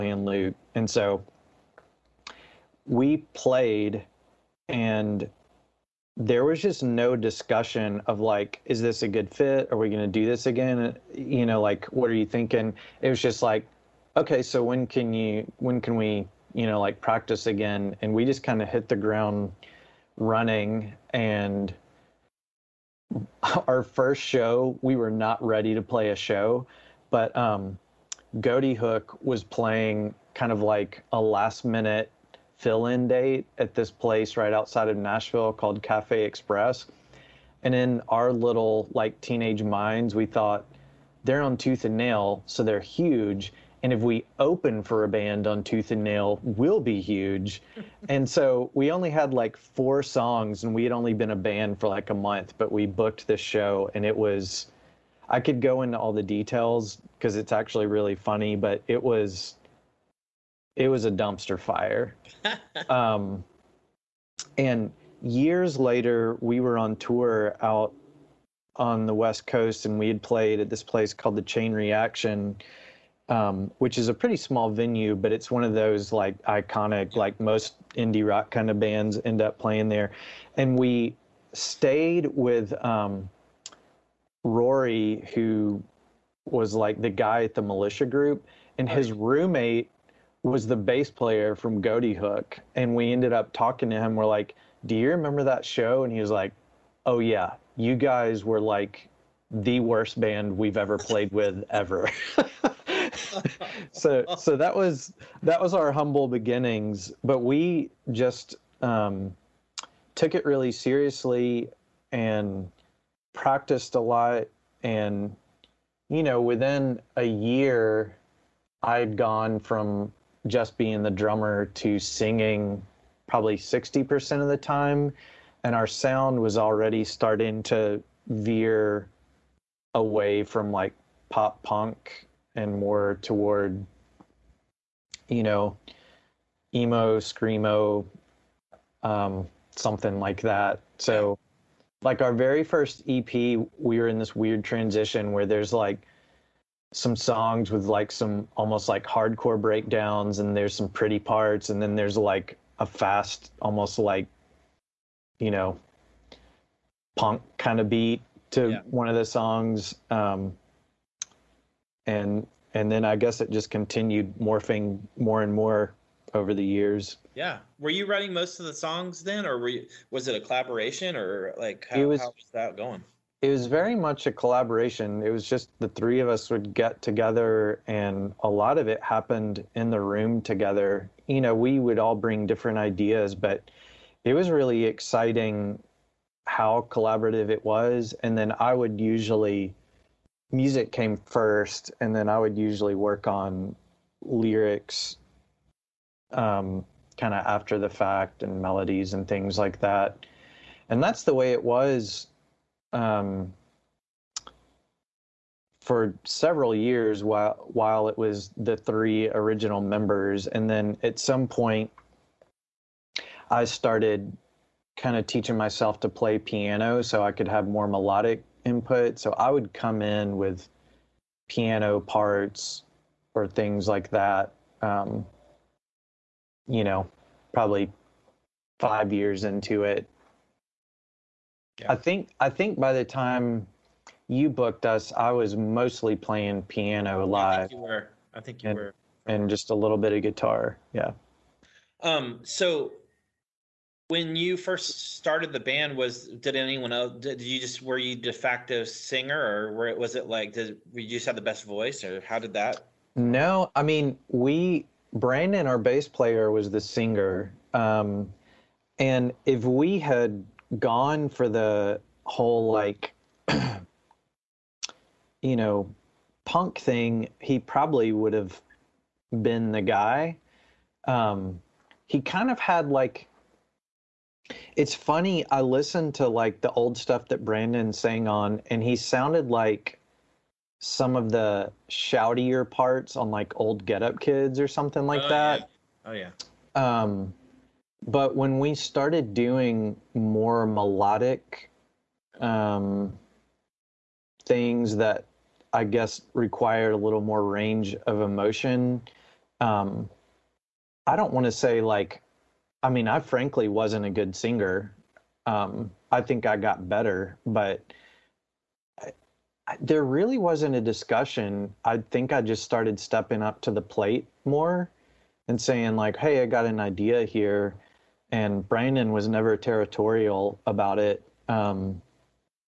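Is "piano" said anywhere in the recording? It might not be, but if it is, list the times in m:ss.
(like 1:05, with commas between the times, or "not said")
3:36, 3:41, 3:56.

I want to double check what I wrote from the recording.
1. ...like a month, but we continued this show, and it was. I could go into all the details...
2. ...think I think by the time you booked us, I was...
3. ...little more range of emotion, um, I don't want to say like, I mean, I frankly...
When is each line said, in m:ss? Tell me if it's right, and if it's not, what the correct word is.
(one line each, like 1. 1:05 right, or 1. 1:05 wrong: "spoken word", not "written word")
1. 0:51 wrong: "booked", not "continued"
2. 3:51 right
3. 4:56 right.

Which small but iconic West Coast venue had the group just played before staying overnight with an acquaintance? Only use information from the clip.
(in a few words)
Chain Reaction.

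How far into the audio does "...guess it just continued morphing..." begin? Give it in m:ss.
2:43.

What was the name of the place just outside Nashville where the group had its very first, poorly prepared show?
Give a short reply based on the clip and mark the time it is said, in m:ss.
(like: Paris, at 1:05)
Cafe Express, at 0:35.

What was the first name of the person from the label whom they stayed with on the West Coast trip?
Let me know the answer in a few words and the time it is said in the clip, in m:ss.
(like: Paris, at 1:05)
Rory, at 1:24.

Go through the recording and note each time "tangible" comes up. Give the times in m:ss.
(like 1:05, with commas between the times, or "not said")
not said.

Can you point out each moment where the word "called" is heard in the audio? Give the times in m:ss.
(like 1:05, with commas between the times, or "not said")
0:35, 1:11.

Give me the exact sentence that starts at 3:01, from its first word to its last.
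You know, we would all bring different ideas, but it was really exciting how collaborative it was.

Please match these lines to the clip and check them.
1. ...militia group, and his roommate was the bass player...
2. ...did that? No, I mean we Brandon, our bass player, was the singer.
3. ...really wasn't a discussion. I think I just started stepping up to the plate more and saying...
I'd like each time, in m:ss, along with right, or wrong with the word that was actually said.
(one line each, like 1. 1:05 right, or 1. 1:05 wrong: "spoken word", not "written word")
1. 1:27 right
2. 4:12 right
3. 5:10 right.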